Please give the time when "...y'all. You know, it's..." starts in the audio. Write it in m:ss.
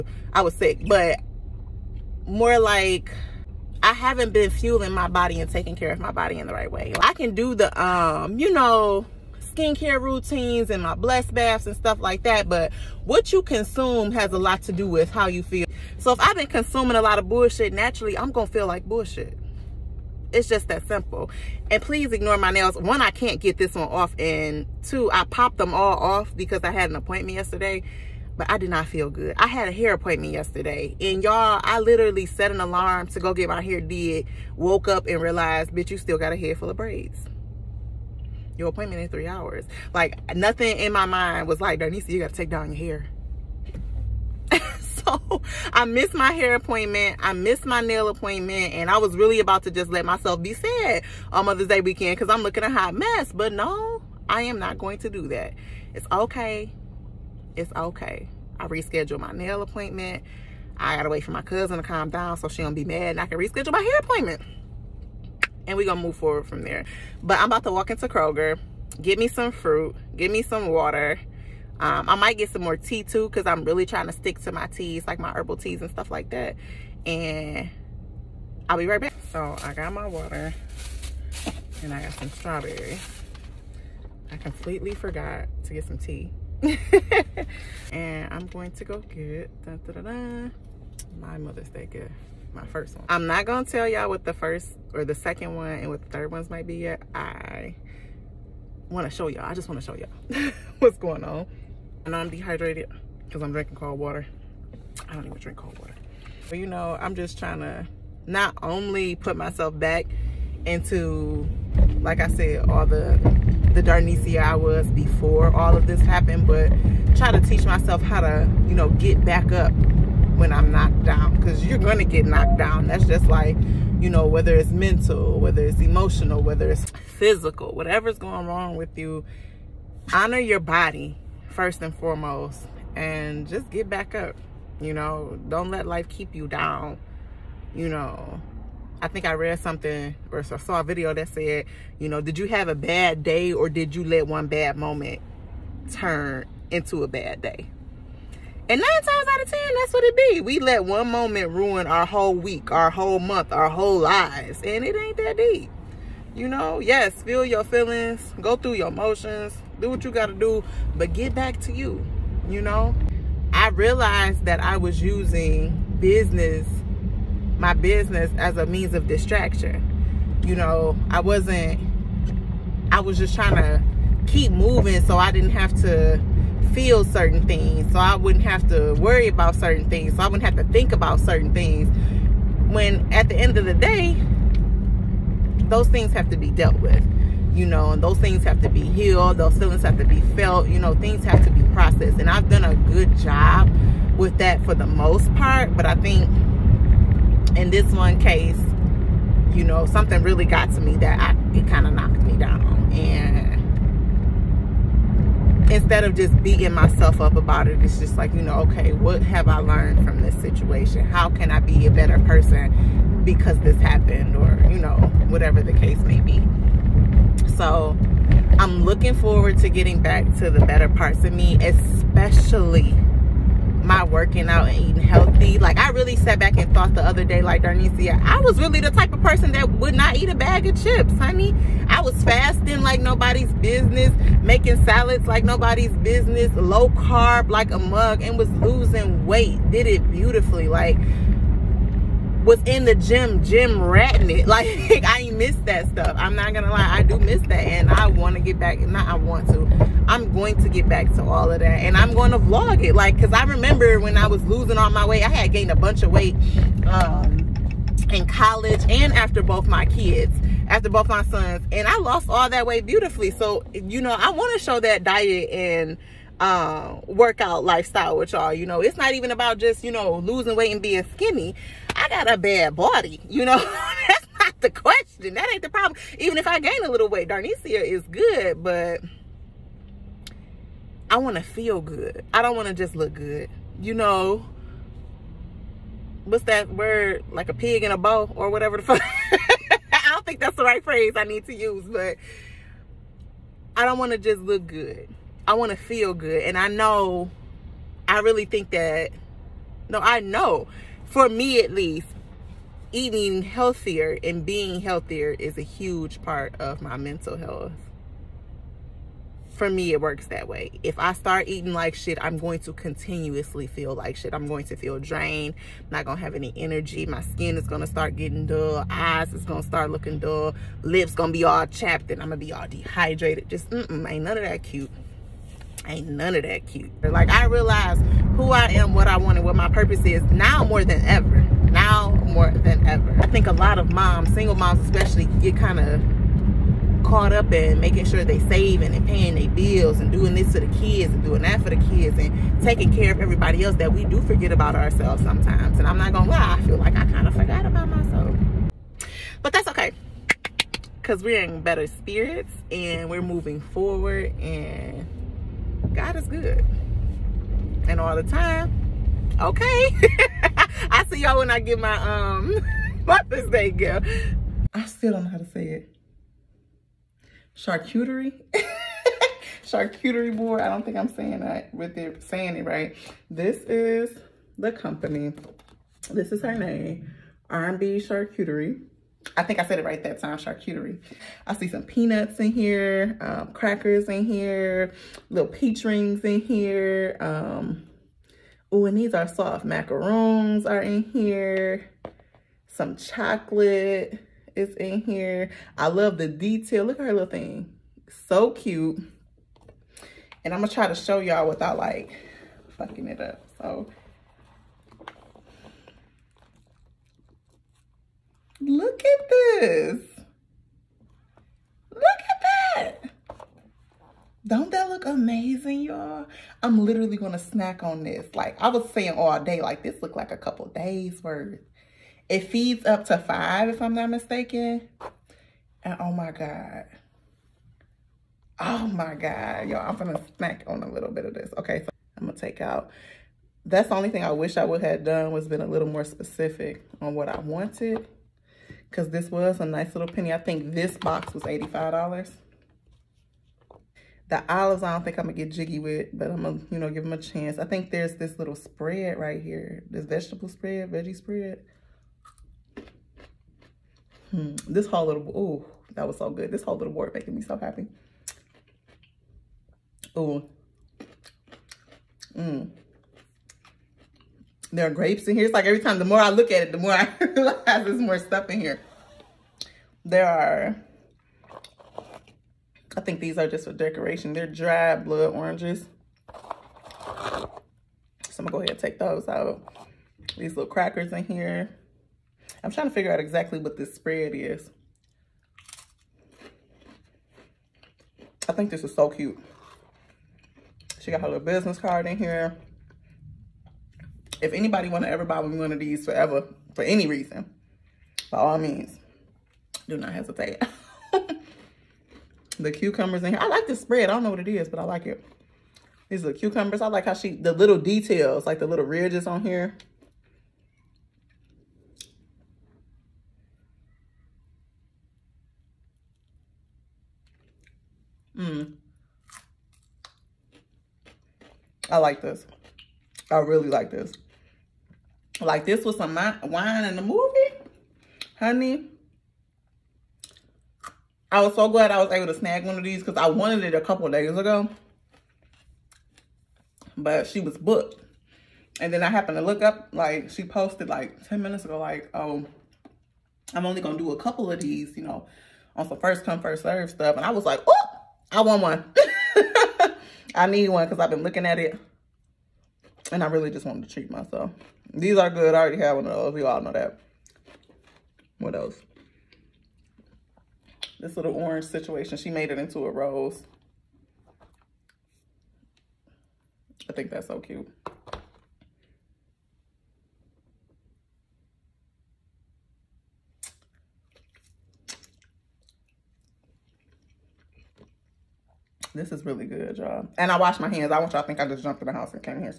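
4:28.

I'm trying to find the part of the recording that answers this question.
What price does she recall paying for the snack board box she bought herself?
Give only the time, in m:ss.
7:21.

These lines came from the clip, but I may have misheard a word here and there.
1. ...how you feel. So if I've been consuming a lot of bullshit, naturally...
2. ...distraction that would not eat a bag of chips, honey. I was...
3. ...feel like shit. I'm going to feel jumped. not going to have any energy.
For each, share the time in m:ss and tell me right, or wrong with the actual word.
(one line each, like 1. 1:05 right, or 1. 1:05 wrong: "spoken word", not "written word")
1. 0:15 right
2. 3:49 wrong: "person", not "distraction"
3. 5:13 wrong: "drained", not "jumped".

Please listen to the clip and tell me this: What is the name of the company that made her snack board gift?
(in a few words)
R&B Charcuterie.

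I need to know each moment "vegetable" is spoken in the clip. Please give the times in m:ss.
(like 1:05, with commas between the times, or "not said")
7:30.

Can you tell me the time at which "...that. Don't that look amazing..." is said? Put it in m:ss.
6:52.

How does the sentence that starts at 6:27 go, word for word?
Um, oh, and these are soft macaroons are in here.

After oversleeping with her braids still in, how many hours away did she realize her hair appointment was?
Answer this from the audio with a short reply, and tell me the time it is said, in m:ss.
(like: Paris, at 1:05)
3, at 0:39.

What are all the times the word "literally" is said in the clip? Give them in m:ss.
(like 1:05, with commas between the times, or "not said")
0:31, 6:56.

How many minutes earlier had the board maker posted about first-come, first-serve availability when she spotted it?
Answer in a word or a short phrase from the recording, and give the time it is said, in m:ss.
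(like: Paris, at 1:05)
10, at 9:01.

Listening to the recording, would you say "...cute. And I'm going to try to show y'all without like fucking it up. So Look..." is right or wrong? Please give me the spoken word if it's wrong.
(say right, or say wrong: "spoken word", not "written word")
right.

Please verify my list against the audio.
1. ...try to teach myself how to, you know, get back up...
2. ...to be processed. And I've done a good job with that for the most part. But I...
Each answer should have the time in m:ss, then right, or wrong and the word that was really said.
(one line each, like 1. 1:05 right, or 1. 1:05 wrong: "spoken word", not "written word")
1. 1:57 right
2. 3:11 right.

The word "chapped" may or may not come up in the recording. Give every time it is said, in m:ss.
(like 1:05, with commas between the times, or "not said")
5:21.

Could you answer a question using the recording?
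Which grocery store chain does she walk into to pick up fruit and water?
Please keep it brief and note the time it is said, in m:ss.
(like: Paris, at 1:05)
Kroger, at 1:08.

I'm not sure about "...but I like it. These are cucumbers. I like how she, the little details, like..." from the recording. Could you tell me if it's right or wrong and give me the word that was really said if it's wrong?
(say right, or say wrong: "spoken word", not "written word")
right.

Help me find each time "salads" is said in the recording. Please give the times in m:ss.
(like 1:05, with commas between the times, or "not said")
3:54.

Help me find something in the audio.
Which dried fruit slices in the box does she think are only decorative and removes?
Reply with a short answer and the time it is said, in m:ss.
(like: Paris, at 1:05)
Blood oranges, at 7:54.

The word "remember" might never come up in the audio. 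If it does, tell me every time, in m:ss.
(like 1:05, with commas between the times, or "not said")
4:13.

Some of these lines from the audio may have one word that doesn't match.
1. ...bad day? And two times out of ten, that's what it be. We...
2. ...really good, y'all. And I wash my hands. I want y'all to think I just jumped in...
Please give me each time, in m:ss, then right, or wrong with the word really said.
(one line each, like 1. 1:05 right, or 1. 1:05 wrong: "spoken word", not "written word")
1. 2:27 wrong: "nine", not "two"
2. 9:39 right.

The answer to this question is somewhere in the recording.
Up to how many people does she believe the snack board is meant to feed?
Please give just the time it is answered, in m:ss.
7:03.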